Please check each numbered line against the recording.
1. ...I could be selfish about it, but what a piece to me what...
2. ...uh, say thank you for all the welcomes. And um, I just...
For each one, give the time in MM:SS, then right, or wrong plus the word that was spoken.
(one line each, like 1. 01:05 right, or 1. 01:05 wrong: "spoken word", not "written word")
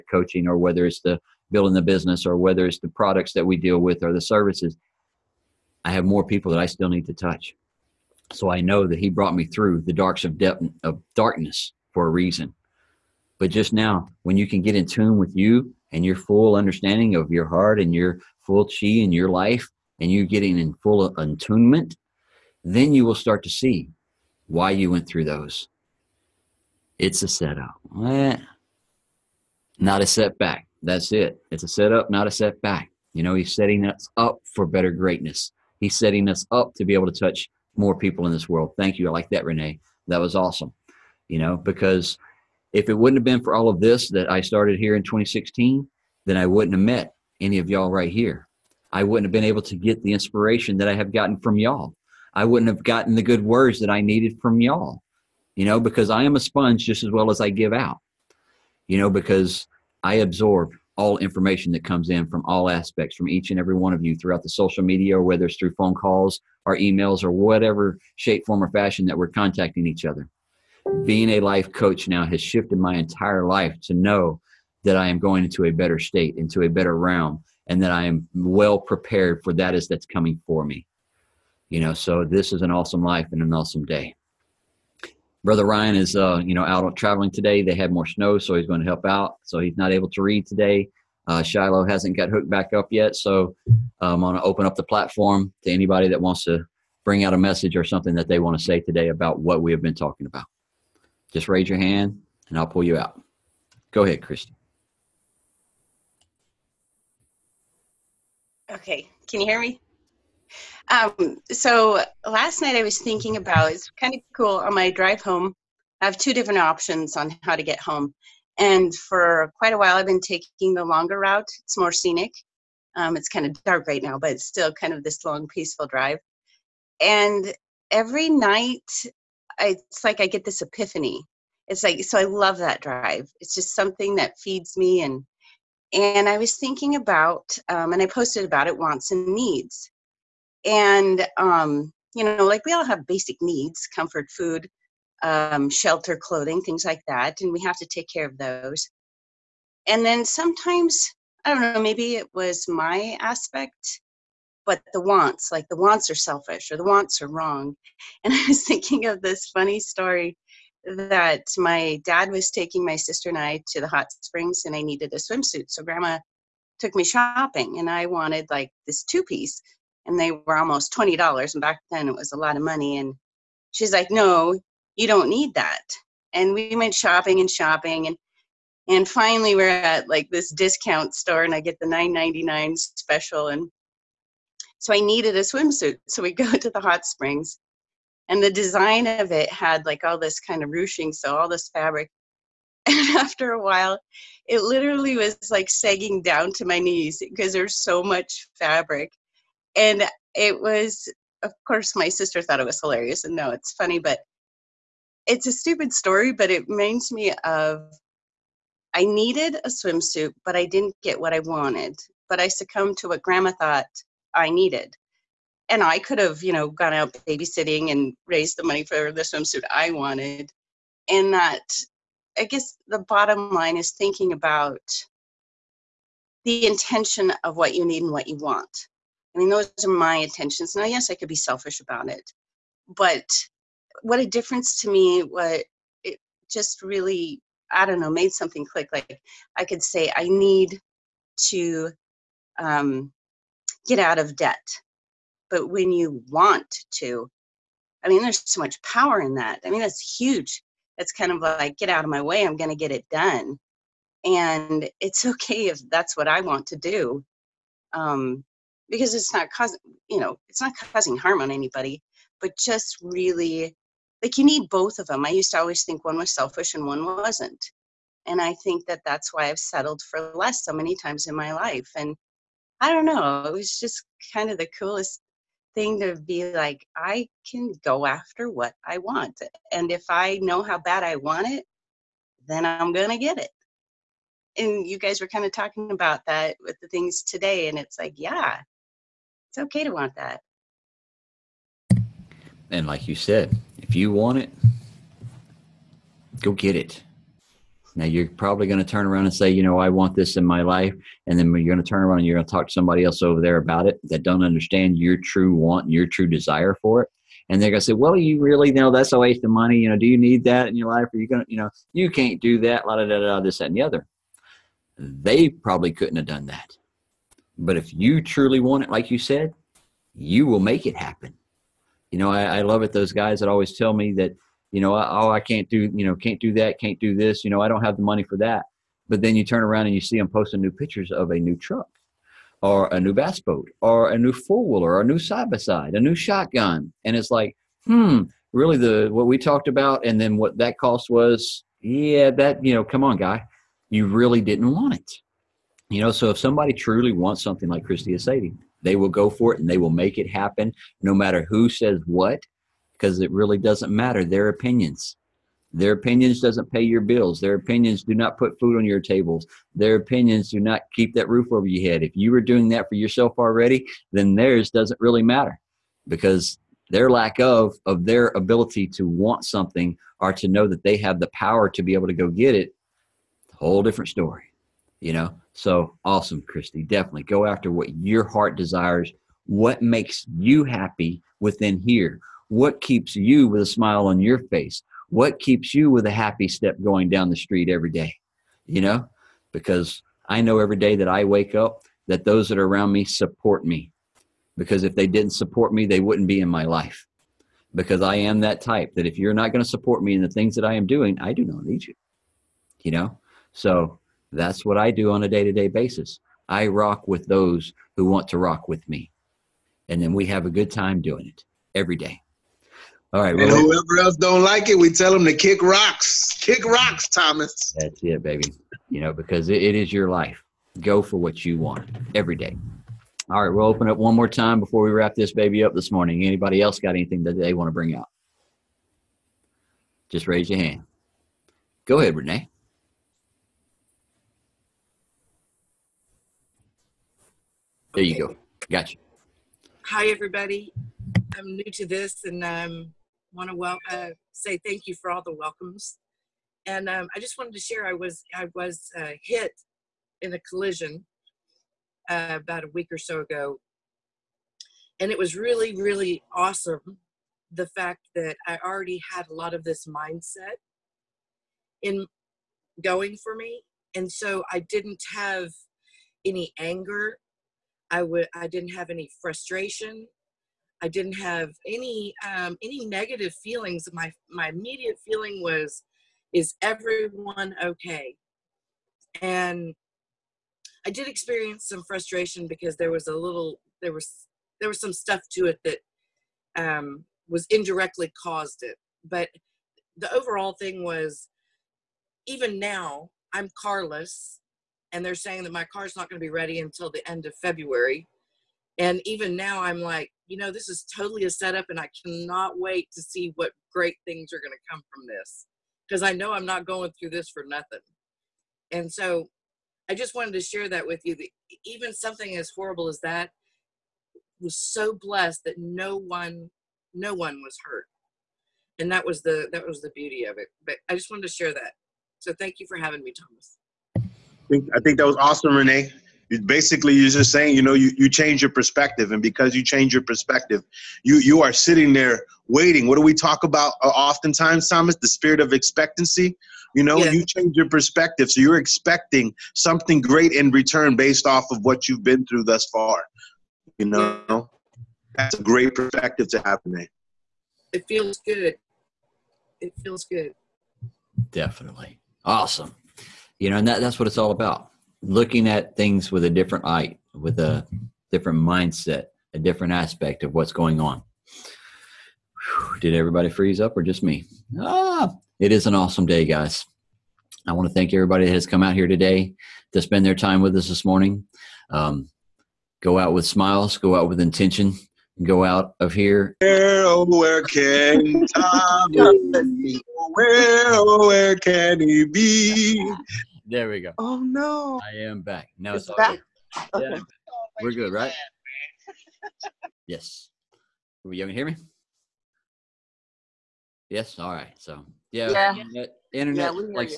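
1. 03:51 wrong: "difference", not "piece"
2. 07:23 right.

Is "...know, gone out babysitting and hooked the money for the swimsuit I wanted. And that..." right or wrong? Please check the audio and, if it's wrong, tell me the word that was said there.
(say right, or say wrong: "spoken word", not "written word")
wrong: "raised", not "hooked".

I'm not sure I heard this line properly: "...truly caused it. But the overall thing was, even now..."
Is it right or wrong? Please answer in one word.
wrong.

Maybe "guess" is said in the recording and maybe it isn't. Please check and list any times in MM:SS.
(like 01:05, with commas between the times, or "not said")
03:42.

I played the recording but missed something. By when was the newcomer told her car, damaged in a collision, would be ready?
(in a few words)
end of February.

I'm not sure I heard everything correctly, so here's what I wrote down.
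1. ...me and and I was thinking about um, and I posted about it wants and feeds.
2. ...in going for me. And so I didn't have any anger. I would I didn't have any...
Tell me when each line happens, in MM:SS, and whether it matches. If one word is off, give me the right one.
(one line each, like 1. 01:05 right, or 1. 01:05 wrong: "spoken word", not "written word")
1. 02:14 wrong: "needs", not "feeds"
2. 07:41 right.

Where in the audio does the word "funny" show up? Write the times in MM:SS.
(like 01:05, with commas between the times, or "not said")
02:39, 03:23.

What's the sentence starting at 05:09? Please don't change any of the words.
You know, do you need that in your life?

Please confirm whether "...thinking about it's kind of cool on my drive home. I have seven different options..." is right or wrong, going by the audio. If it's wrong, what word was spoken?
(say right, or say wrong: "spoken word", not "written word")
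wrong: "two", not "seven".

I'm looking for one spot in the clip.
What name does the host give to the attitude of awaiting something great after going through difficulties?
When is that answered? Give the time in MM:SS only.
08:55.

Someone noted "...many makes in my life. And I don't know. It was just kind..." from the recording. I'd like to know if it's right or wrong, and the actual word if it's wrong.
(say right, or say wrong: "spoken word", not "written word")
wrong: "times", not "makes".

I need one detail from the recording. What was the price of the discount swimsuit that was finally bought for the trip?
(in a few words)
9.99.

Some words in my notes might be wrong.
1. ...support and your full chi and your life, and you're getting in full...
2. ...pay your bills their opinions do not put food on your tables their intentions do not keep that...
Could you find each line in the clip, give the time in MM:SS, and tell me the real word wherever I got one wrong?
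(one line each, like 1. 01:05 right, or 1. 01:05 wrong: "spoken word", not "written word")
1. 00:17 wrong: "heart", not "support"
2. 05:56 wrong: "opinions", not "intentions".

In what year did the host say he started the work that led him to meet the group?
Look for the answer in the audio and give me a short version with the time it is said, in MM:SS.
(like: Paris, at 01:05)
2016, at 00:45.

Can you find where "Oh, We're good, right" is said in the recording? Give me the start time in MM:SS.
09:46.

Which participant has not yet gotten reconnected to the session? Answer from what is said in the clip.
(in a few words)
Shiloh.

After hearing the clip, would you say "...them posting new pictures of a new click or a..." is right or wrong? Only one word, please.
wrong.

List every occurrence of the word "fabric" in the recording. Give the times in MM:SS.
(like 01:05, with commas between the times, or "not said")
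03:11, 03:18.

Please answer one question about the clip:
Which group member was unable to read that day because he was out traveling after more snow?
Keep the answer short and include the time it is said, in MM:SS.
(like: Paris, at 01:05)
Ryan, at 01:25.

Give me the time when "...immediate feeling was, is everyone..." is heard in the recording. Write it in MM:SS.
07:54.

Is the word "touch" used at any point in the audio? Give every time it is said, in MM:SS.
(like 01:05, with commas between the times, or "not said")
00:07, 00:37.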